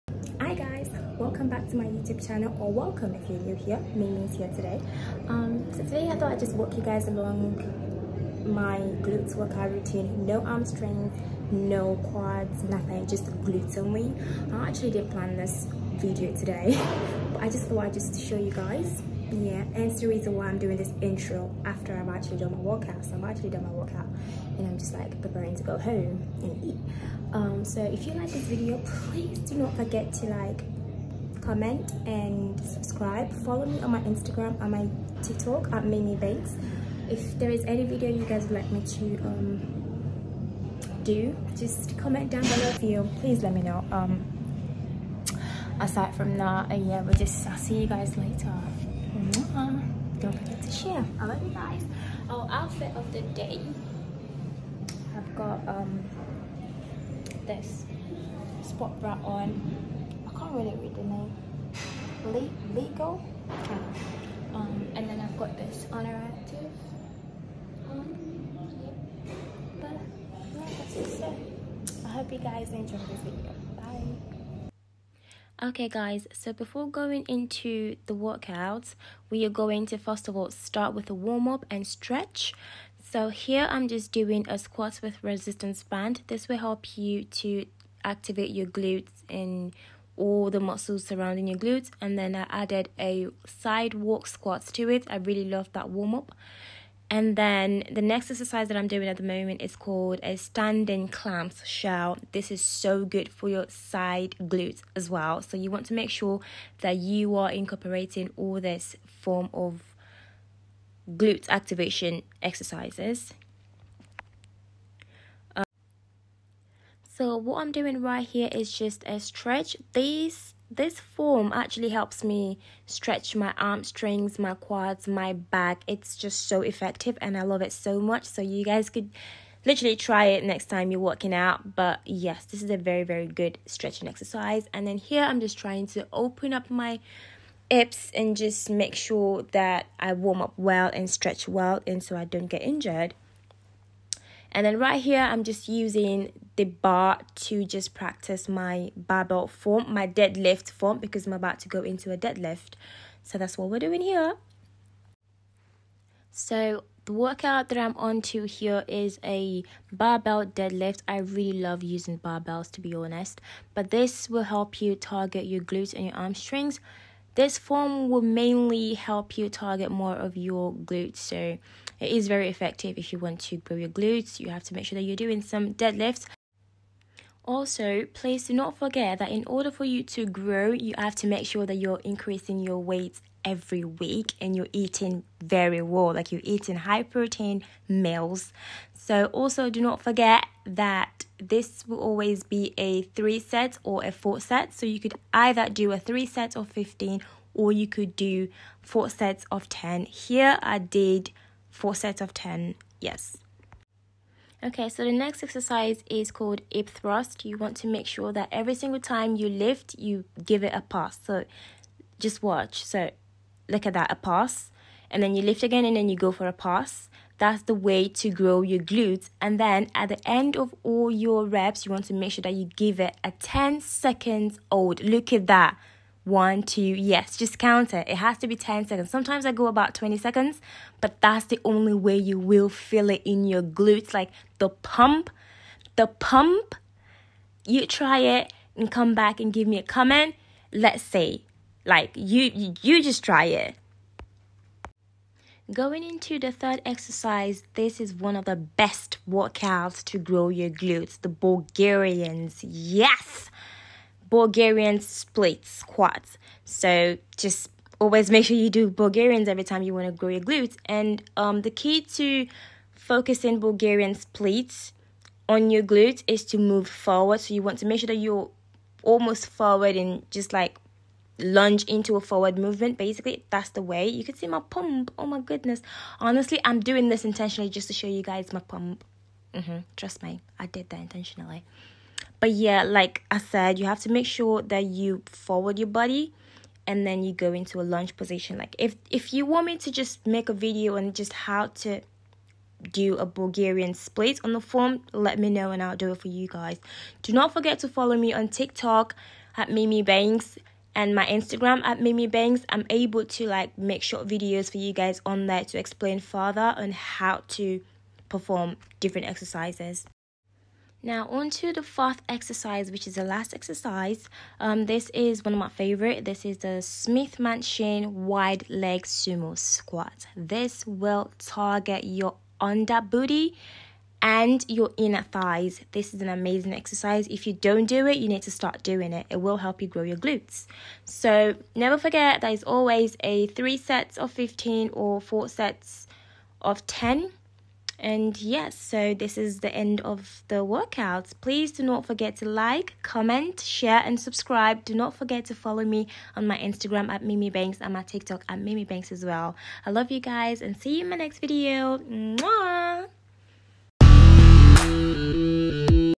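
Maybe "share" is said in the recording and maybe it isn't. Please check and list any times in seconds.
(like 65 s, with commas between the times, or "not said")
50 s, 343 s.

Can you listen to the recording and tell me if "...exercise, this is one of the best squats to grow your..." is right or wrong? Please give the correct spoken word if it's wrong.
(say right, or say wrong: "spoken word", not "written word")
wrong: "workouts", not "squats".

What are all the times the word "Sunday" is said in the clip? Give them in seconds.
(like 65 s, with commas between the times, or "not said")
not said.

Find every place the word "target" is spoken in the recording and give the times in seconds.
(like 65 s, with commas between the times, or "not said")
164 s, 169 s, 321 s.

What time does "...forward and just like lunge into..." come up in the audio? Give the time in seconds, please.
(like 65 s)
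269 s.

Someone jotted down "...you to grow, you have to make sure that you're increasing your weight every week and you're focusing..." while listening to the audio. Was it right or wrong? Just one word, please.
wrong.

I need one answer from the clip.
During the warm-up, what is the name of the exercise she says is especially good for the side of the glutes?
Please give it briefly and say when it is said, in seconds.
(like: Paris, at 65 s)
standing clamshell, at 100 s.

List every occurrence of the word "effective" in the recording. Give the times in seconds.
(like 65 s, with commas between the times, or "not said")
126 s, 172 s.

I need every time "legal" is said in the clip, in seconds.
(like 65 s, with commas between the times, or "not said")
62 s.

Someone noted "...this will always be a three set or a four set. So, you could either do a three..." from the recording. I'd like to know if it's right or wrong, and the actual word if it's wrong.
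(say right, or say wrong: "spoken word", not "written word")
right.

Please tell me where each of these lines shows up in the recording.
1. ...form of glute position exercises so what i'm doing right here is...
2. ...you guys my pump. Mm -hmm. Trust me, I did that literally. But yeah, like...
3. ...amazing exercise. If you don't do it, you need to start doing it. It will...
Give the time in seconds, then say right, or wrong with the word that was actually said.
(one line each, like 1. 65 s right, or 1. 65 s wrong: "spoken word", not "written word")
1. 109 s wrong: "activation", not "position"
2. 278 s wrong: "intentionally", not "literally"
3. 326 s right.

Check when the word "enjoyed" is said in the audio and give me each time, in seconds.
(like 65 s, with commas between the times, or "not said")
72 s.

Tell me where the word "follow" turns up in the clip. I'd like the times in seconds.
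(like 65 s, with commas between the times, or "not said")
33 s, 297 s, 345 s.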